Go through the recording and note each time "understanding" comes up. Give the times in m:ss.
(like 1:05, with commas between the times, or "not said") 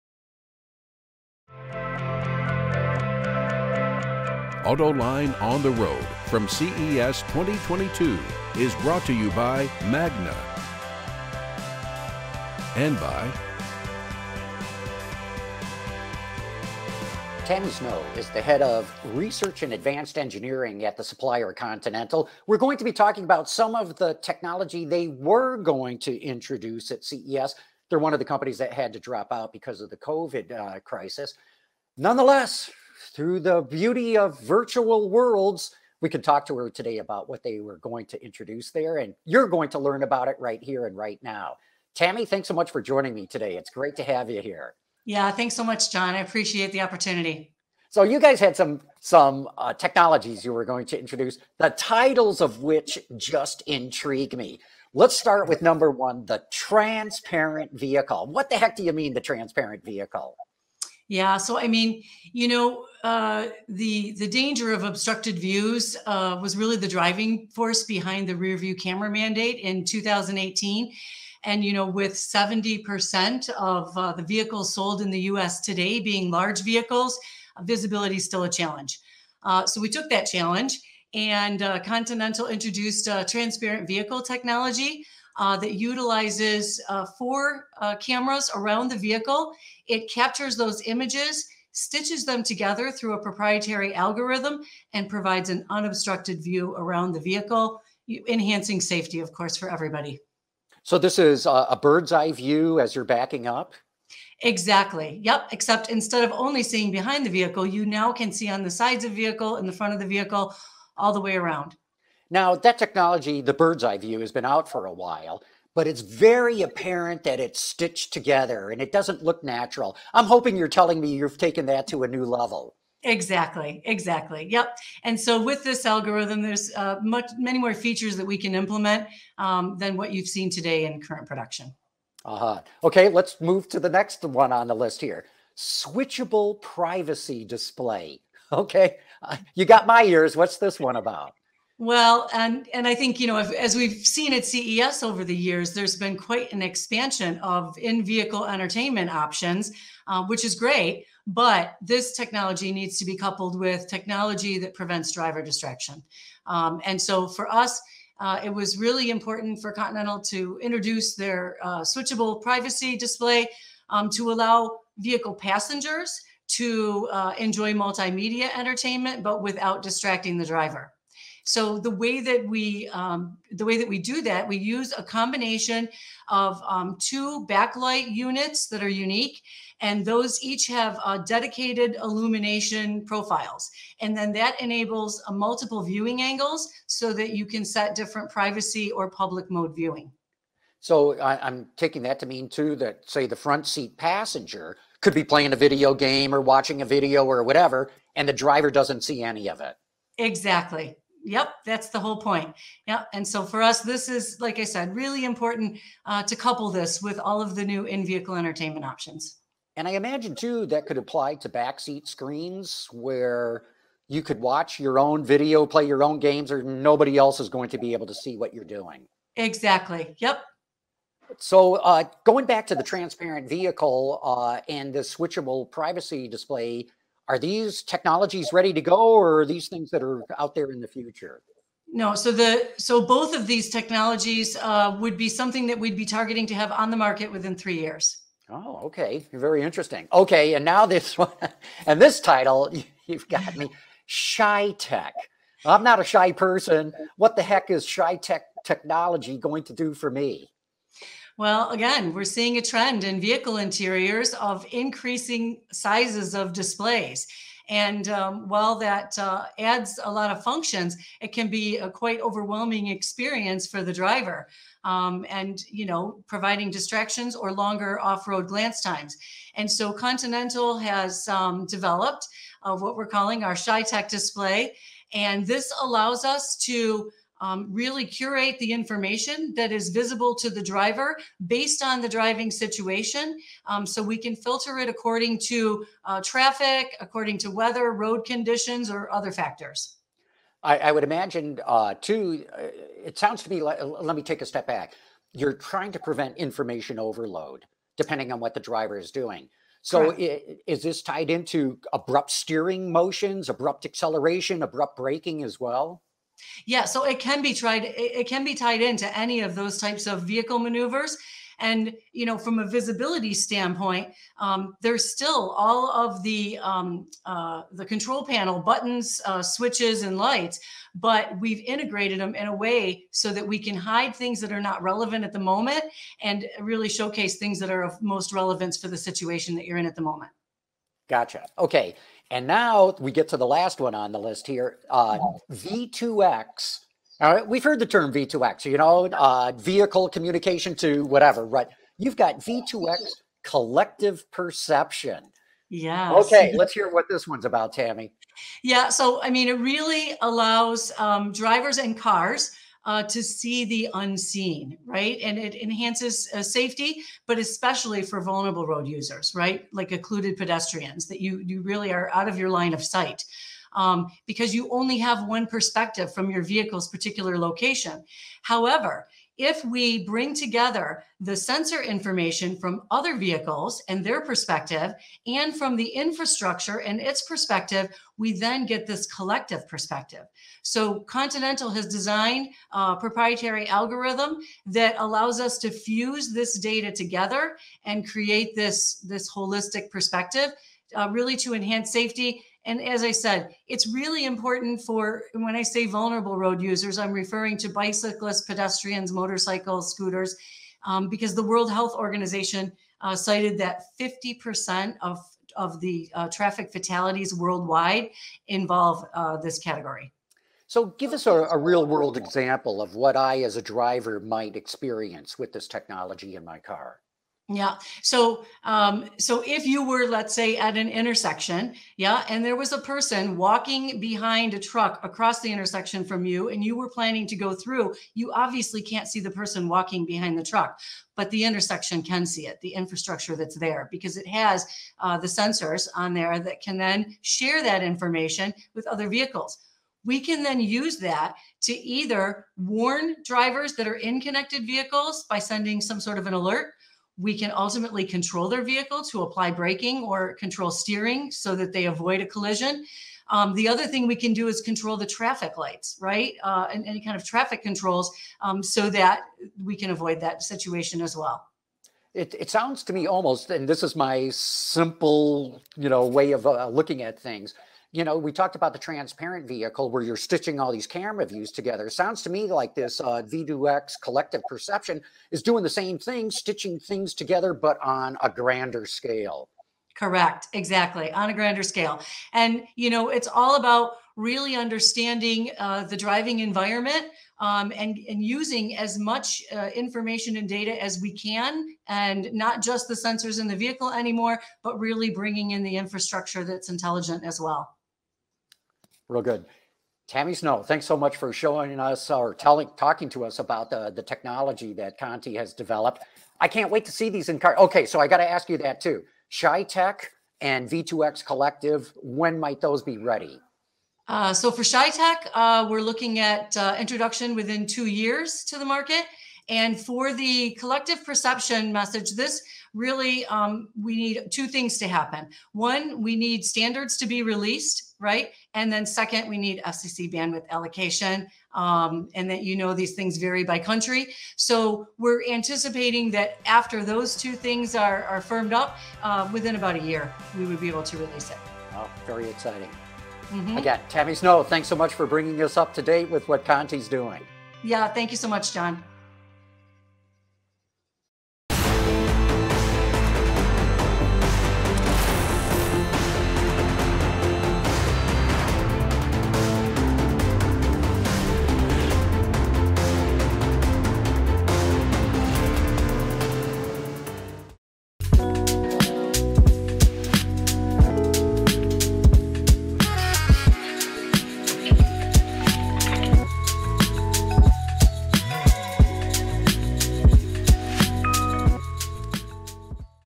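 8:04.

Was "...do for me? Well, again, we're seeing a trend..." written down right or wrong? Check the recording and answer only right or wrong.
right.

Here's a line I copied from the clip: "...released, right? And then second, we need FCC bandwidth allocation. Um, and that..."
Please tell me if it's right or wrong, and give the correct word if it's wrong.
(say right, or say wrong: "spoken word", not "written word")
right.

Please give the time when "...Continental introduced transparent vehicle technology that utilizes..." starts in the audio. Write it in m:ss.
1:21.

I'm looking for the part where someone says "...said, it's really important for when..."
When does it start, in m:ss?
6:33.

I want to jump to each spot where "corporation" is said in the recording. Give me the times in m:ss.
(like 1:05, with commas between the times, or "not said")
not said.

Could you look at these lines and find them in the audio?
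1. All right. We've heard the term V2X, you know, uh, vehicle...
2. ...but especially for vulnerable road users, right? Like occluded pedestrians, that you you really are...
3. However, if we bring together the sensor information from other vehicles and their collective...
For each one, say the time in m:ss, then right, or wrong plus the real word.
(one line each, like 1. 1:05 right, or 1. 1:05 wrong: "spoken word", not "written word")
1. 5:37 right
2. 5:57 right
3. 6:08 wrong: "perspective", not "collective".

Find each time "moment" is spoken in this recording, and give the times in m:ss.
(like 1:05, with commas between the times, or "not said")
5:25, 5:30.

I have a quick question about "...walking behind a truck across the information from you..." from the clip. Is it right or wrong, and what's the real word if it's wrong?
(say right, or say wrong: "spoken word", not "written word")
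wrong: "intersection", not "information".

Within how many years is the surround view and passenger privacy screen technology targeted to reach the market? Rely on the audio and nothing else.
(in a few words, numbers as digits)
3 years.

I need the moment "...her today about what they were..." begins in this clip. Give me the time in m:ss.
0:36.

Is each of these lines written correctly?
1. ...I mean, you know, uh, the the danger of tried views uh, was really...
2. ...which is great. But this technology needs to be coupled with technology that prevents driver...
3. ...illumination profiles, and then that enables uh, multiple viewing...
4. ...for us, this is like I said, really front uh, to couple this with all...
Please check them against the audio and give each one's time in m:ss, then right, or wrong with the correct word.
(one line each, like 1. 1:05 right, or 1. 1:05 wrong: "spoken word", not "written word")
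1. 1:01 wrong: "obstructed", not "tried"
2. 2:30 right
3. 3:02 right
4. 3:23 wrong: "important", not "front".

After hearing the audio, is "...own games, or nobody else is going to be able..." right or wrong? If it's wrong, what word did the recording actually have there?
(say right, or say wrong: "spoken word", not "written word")
right.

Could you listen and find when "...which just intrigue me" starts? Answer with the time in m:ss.
0:52.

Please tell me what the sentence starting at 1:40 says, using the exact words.
So this is a bird's eye view as you're backing up?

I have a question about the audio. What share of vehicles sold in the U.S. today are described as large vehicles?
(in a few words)
70%.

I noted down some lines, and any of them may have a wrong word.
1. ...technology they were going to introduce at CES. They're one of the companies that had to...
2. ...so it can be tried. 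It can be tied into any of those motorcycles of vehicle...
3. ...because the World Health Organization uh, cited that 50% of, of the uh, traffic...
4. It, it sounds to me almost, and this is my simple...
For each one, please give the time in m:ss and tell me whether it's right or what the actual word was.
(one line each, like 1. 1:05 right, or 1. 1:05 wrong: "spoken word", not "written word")
1. 0:24 right
2. 5:06 wrong: "types", not "motorcycles"
3. 6:41 right
4. 7:42 right.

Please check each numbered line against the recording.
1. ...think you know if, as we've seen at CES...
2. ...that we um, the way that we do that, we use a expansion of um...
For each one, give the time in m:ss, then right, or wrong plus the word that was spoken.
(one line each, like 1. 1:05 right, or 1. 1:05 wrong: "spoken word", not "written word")
1. 2:22 right
2. 2:52 wrong: "combination", not "expansion".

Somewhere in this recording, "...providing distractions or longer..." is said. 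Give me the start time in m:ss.
4:26.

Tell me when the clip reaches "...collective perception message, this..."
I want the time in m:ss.
8:40.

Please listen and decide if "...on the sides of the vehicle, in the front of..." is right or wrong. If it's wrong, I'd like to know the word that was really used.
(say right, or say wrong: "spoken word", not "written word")
right.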